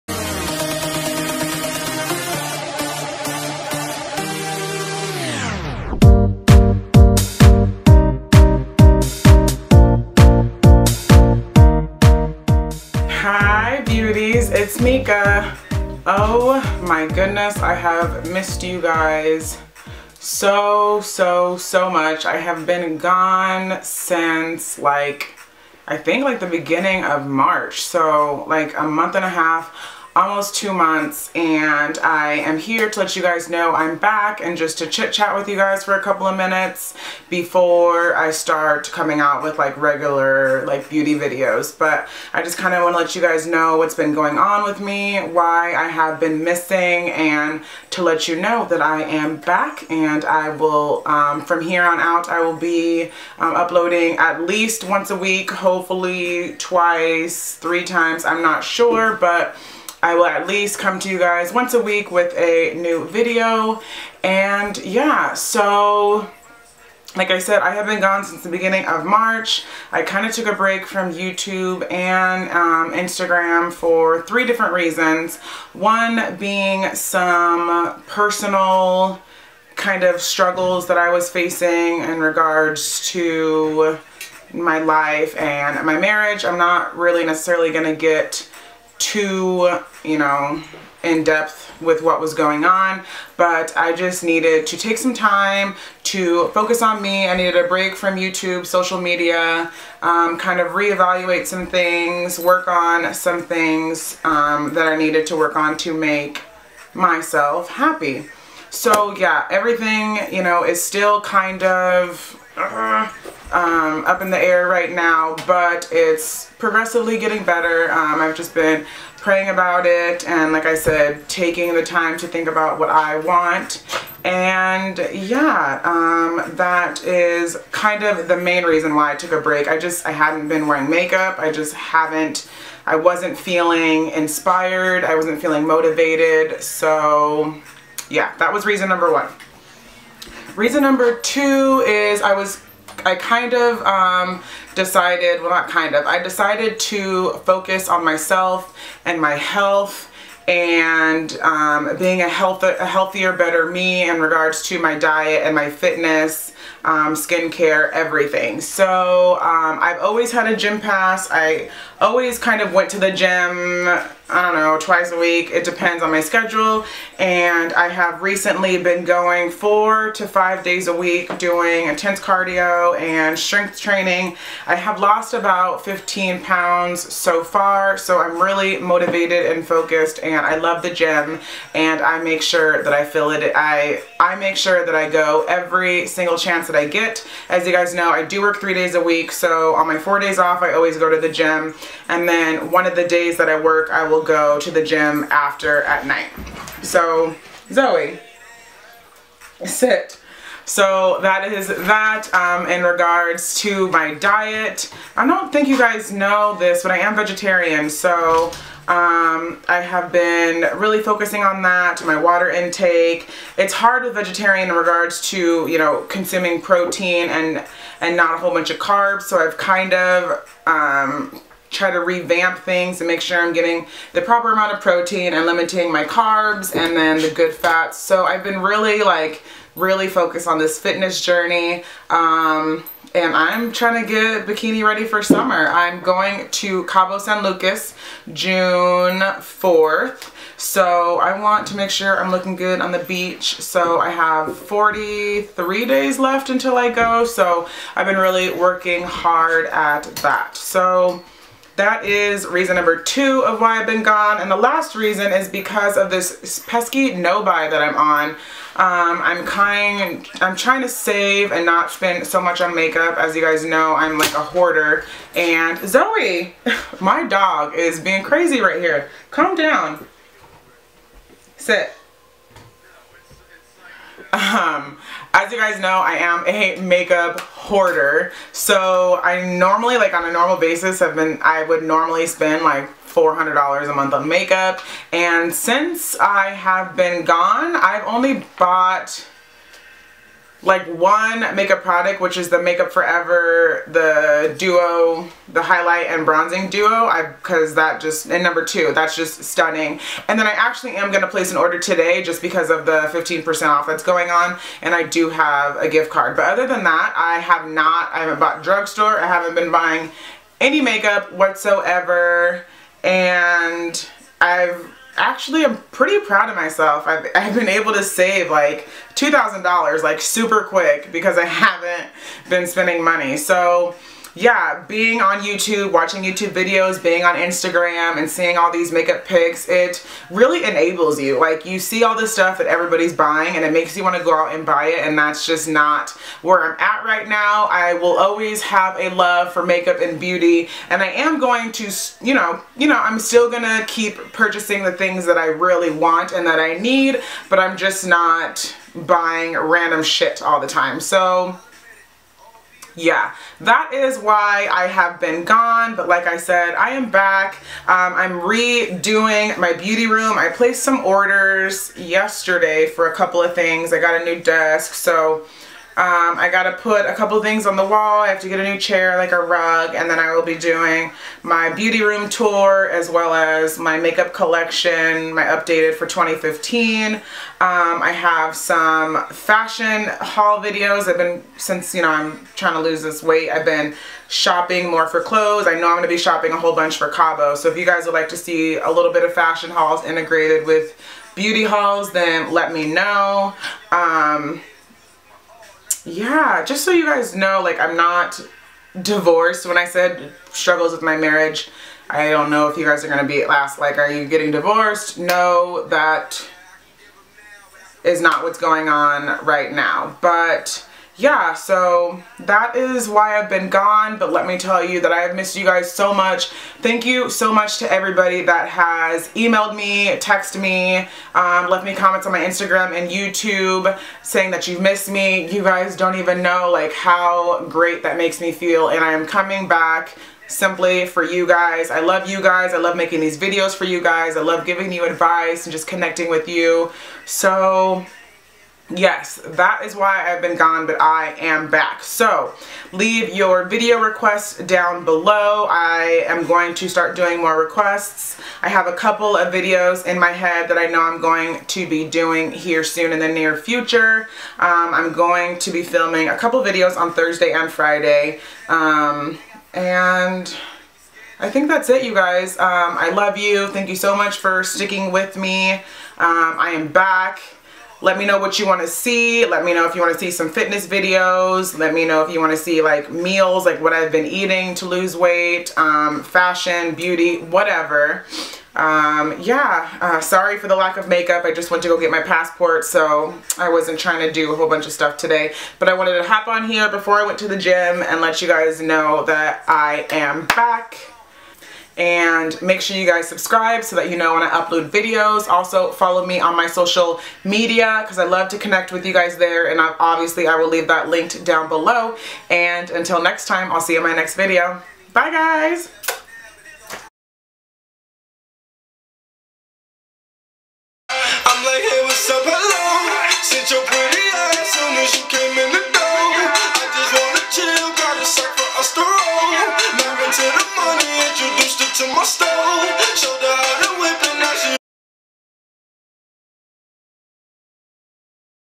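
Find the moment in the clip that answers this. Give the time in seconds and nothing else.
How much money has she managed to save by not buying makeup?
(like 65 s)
319 s.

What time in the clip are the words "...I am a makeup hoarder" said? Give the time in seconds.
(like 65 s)
275 s.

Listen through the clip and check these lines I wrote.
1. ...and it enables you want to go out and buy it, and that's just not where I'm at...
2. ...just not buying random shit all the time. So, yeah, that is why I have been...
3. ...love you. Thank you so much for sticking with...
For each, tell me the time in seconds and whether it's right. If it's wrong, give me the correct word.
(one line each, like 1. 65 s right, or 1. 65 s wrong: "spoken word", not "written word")
1. 333 s wrong: "makes", not "enables"
2. 347 s right
3. 463 s right.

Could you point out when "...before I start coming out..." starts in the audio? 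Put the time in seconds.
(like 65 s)
37 s.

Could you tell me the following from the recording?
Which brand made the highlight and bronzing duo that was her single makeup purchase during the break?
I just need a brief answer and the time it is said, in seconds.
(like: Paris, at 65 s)
Makeup Forever, at 292 s.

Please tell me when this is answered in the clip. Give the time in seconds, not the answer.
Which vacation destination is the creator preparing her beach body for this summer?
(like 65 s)
236 s.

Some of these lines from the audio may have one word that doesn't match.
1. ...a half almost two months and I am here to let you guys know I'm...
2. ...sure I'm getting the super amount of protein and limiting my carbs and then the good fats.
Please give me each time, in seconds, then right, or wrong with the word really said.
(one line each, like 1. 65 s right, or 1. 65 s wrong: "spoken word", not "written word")
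1. 29 s right
2. 223 s wrong: "proper", not "super".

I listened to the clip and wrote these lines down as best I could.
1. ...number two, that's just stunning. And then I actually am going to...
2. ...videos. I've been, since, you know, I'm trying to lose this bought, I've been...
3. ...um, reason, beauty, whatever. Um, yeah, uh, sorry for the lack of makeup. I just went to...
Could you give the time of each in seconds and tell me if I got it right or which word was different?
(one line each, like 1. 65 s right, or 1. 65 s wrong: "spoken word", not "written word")
1. 298 s right
2. 380 s wrong: "weight", not "bought"
3. 475 s wrong: "fashion", not "reason".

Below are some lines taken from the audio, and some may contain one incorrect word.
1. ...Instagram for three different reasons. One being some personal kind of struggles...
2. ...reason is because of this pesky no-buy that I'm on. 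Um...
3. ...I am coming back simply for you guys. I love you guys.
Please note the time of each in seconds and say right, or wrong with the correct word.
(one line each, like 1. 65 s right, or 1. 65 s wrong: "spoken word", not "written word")
1. 72 s right
2. 254 s right
3. 429 s right.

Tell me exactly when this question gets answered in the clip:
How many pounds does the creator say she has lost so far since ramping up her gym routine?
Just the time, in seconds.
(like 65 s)
175 s.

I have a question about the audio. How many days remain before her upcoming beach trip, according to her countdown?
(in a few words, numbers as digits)
43.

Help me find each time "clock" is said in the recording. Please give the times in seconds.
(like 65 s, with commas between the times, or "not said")
not said.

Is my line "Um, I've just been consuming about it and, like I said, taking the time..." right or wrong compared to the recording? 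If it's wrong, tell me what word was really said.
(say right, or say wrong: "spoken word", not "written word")
wrong: "praying", not "consuming".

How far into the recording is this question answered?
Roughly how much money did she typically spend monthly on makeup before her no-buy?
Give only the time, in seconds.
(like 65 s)
283 s.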